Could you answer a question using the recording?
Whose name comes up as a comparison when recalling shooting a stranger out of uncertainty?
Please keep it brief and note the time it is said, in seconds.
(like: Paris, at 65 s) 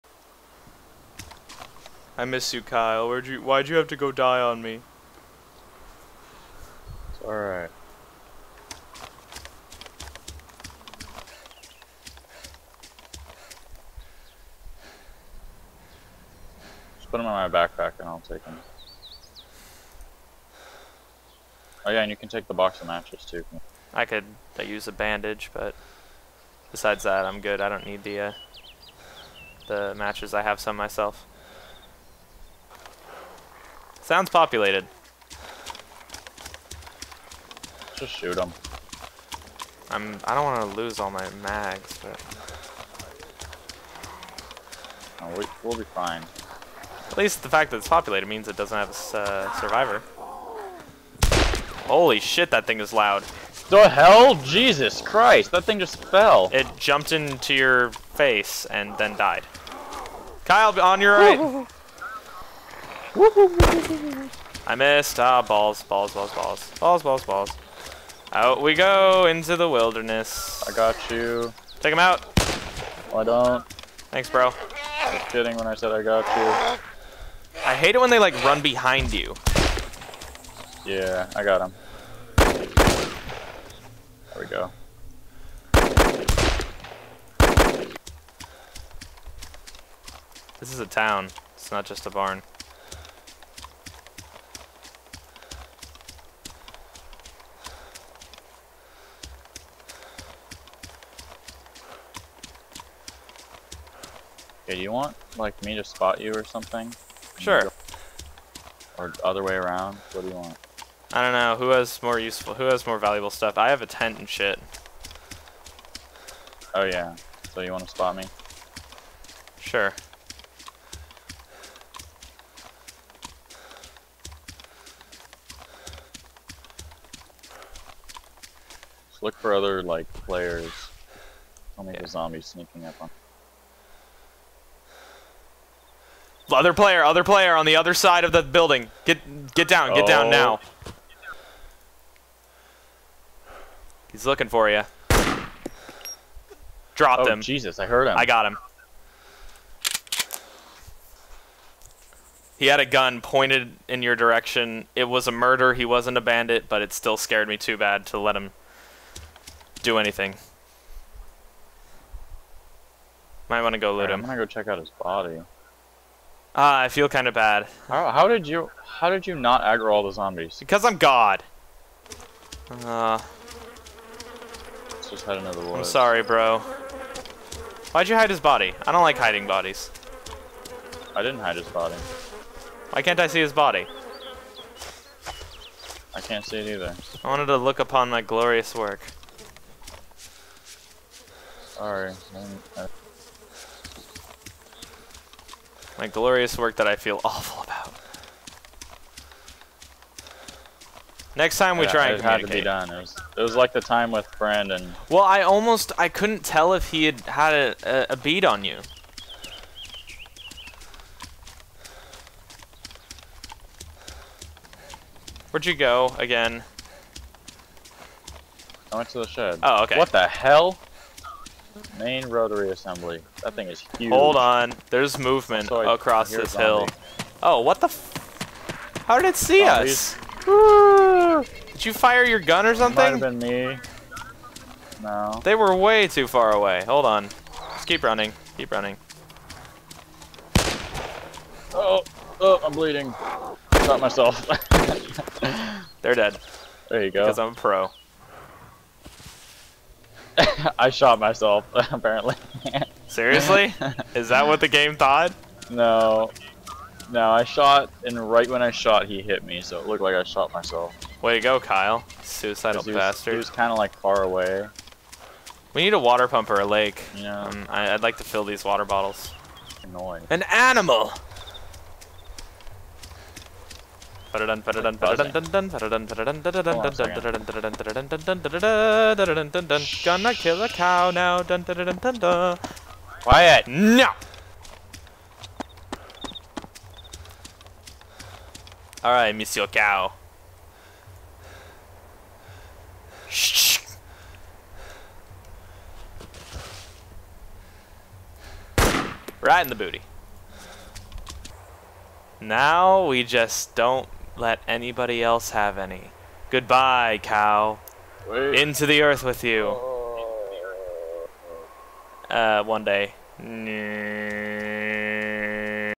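Brandon, at 204 s.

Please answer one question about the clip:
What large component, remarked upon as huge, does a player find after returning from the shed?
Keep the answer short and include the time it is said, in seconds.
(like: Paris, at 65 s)
Main rotary assembly, at 221 s.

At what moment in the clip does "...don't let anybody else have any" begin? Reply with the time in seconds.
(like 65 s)
303 s.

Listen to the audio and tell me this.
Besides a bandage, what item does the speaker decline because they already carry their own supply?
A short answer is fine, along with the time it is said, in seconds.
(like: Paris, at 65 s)
box of matches, at 22 s.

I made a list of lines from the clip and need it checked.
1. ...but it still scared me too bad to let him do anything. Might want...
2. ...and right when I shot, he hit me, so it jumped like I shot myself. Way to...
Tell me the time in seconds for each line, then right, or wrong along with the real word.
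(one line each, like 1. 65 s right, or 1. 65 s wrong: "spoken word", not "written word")
1. 156 s right
2. 258 s wrong: "looked", not "jumped".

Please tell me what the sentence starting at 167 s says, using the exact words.
How, how, did you how did you not aggro all the zombies?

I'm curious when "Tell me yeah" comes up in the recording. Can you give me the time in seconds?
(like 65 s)
131 s.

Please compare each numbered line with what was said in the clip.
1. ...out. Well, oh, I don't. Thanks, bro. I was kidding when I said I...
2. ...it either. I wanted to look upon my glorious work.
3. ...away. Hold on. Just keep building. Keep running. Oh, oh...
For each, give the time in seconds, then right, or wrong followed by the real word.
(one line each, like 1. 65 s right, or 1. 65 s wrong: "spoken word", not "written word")
1. 71 s right
2. 186 s right
3. 236 s wrong: "running", not "building".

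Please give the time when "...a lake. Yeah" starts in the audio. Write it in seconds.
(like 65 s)
266 s.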